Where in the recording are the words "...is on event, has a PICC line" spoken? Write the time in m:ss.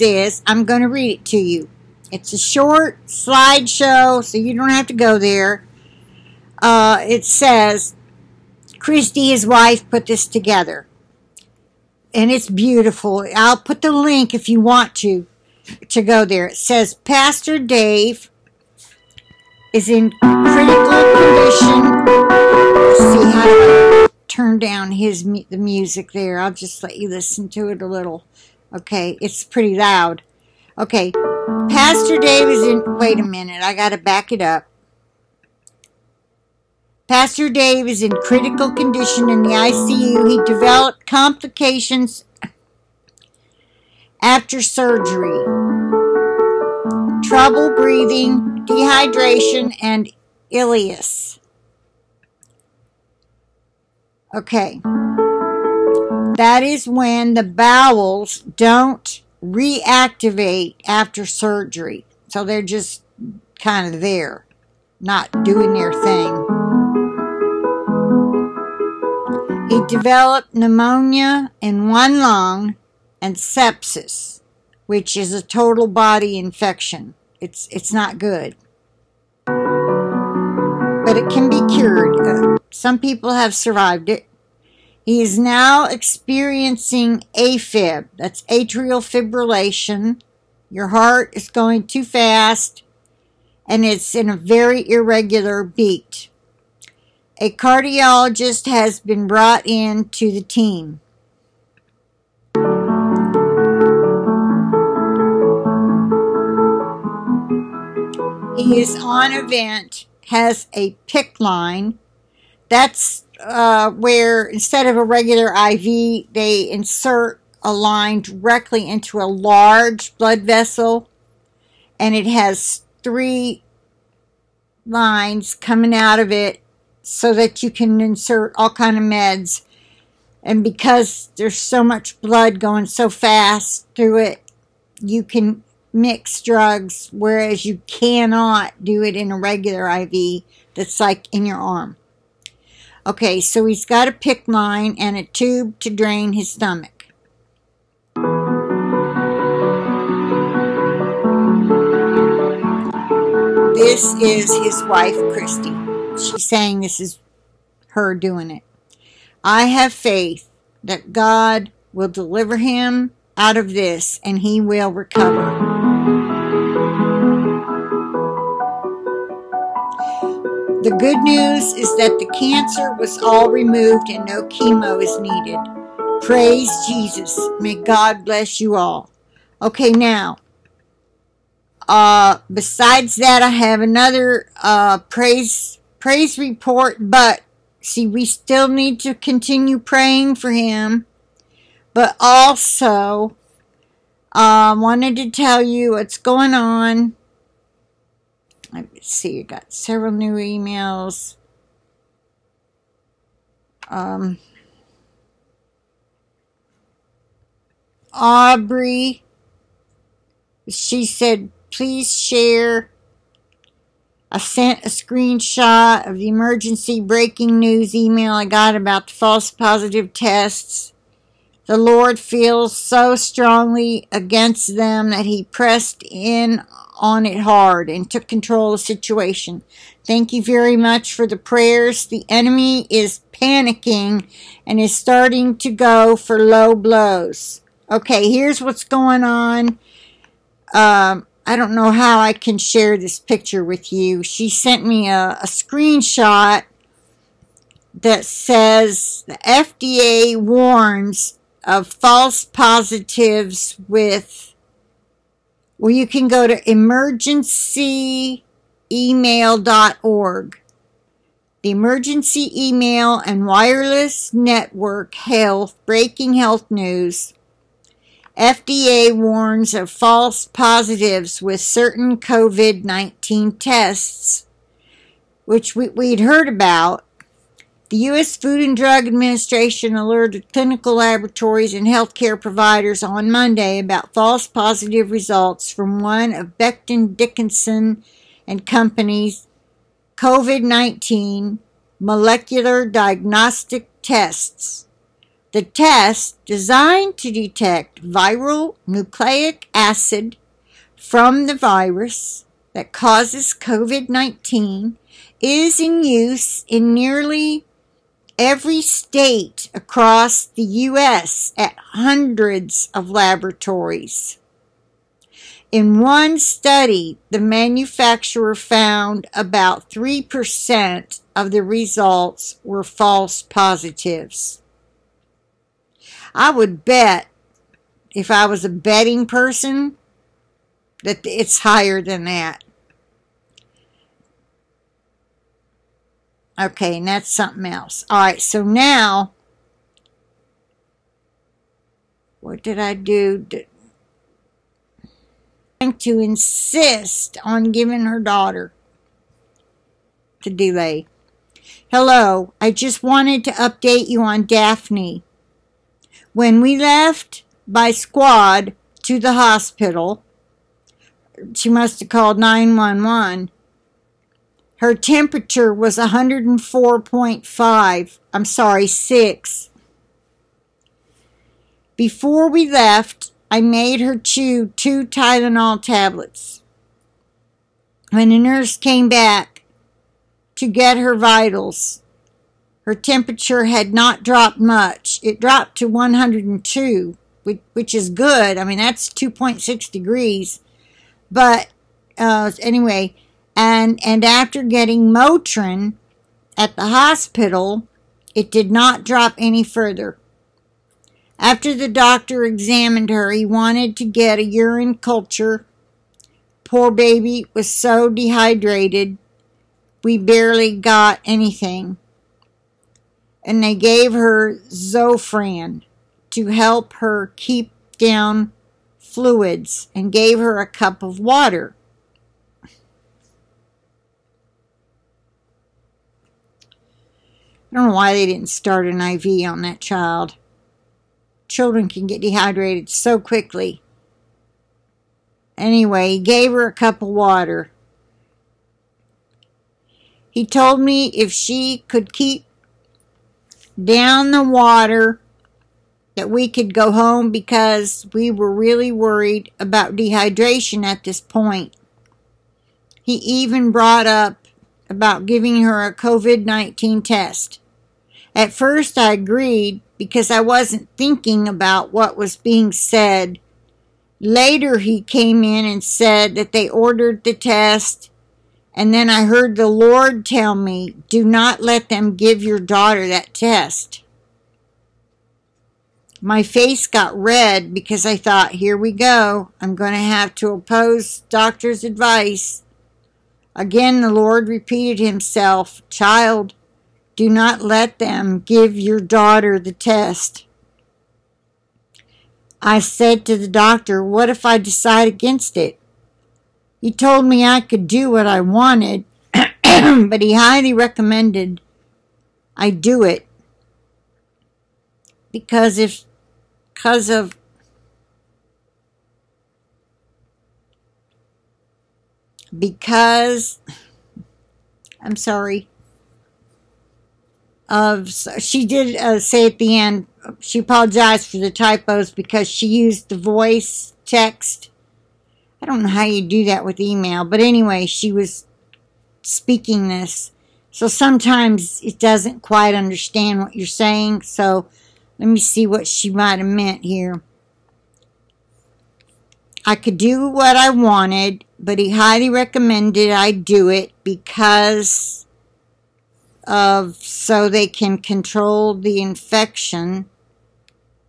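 1:48.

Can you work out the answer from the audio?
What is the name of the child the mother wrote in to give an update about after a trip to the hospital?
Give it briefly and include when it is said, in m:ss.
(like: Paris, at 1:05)
Daphne, at 5:54.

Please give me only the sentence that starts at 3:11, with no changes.
But also, I um, uh, wanted to tell you what's going on.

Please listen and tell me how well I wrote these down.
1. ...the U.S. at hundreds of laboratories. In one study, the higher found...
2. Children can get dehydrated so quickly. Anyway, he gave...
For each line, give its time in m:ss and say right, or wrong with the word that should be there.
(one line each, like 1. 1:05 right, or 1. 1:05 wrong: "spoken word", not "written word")
1. 5:10 wrong: "manufacturer", not "higher"
2. 7:11 right.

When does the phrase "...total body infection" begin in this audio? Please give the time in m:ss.
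1:15.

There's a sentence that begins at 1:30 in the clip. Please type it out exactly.
Your heart is going too fast and it's in a very irregular beat.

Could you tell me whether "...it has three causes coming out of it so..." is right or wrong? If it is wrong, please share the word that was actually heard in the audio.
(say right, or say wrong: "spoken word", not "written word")
wrong: "lines", not "causes".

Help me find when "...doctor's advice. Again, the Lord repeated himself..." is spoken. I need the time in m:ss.
8:01.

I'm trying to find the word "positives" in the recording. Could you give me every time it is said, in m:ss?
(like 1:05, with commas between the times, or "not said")
3:39, 4:12, 4:30, 4:44, 5:23.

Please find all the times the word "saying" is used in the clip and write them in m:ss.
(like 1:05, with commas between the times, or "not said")
2:36, 8:53.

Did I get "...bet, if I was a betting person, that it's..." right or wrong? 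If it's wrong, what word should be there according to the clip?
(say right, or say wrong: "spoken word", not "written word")
right.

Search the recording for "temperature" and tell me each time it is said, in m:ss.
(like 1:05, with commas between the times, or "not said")
6:04, 6:22.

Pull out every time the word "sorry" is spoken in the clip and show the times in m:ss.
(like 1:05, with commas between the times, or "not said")
6:08, 8:35.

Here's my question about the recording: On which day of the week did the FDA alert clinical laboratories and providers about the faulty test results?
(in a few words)
Monday.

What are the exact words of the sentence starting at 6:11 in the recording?
Before we left, I made her chew two Tylenol tablets.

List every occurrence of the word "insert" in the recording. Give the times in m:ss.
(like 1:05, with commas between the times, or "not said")
1:56, 2:08.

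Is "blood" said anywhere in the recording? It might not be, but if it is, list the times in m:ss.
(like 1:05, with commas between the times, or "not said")
2:00, 2:12.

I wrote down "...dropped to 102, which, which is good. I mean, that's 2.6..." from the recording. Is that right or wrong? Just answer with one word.
right.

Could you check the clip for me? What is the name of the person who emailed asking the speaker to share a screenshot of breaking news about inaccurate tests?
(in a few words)
Aubrey.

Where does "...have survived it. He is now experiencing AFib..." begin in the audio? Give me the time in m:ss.
1:23.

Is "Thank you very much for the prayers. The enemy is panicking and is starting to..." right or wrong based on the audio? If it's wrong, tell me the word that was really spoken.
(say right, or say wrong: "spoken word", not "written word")
right.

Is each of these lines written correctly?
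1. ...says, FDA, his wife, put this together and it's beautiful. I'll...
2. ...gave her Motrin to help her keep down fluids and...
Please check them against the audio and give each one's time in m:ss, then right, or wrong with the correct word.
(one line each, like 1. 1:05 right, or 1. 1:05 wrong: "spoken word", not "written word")
1. 0:07 wrong: "Christy", not "FDA"
2. 6:53 wrong: "Zofran", not "Motrin".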